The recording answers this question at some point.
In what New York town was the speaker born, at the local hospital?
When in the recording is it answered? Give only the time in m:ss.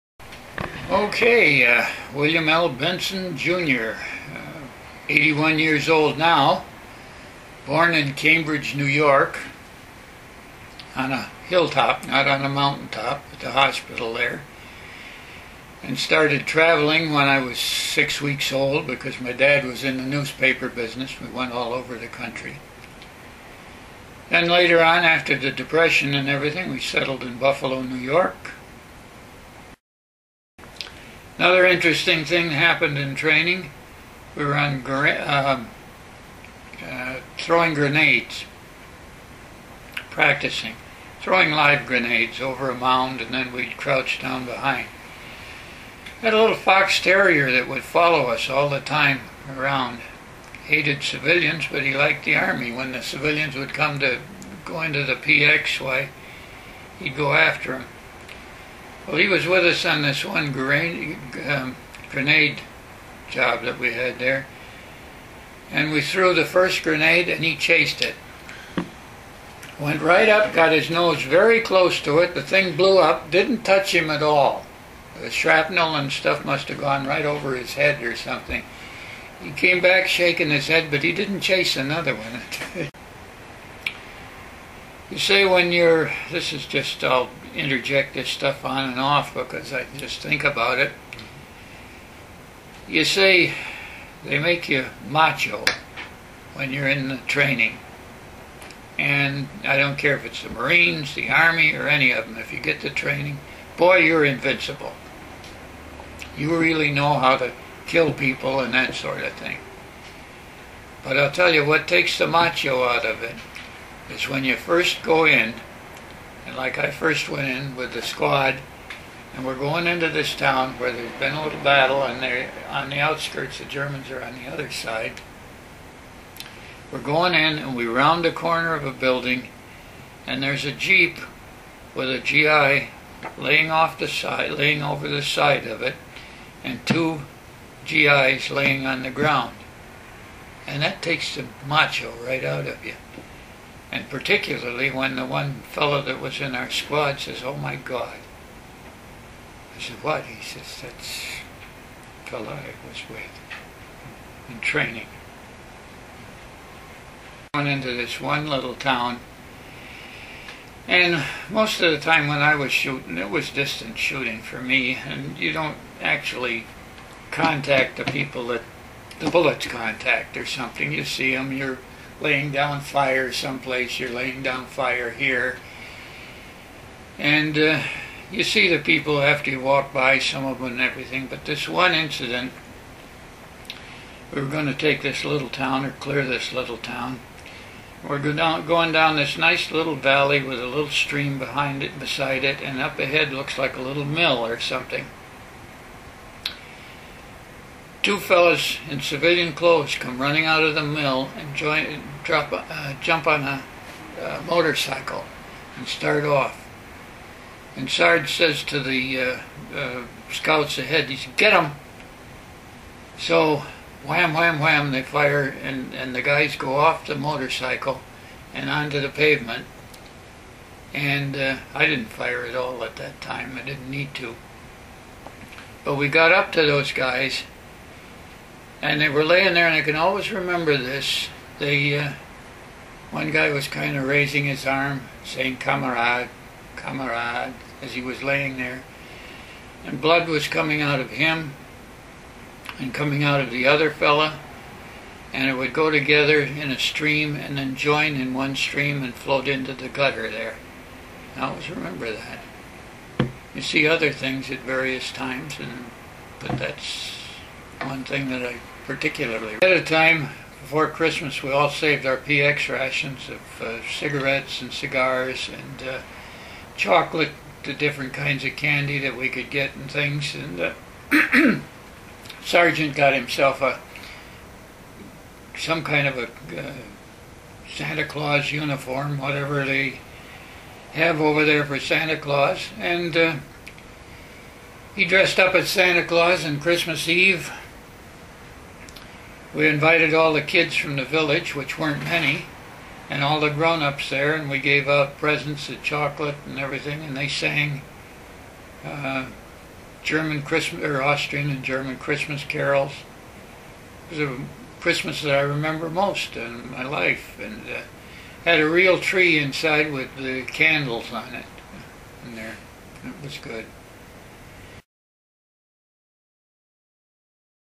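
0:08.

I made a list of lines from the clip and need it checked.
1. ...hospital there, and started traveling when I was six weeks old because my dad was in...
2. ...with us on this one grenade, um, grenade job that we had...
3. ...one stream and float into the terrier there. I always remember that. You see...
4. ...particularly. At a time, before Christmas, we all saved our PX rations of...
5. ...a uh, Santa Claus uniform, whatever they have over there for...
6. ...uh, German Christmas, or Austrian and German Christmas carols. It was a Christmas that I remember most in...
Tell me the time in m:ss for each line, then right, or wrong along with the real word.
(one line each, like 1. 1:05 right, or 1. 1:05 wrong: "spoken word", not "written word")
1. 0:13 right
2. 0:59 right
3. 4:08 wrong: "gutter", not "terrier"
4. 4:18 right
5. 4:36 right
6. 4:58 right.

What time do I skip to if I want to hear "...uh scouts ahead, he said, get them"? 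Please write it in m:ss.
3:29.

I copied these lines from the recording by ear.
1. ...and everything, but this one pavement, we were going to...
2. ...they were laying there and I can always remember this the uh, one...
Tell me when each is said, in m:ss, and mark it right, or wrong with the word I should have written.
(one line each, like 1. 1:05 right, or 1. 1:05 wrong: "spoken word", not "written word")
1. 3:00 wrong: "incident", not "pavement"
2. 3:48 right.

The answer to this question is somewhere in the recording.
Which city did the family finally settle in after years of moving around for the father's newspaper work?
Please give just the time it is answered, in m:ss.
0:27.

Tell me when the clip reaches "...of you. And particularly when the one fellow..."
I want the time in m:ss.
2:22.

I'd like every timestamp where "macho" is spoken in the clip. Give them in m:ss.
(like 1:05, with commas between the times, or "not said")
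1:35, 1:52, 2:21.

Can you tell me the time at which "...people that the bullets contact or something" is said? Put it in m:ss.
2:48.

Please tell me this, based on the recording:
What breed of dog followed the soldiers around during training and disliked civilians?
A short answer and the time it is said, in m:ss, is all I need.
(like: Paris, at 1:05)
Fox terrier, at 0:46.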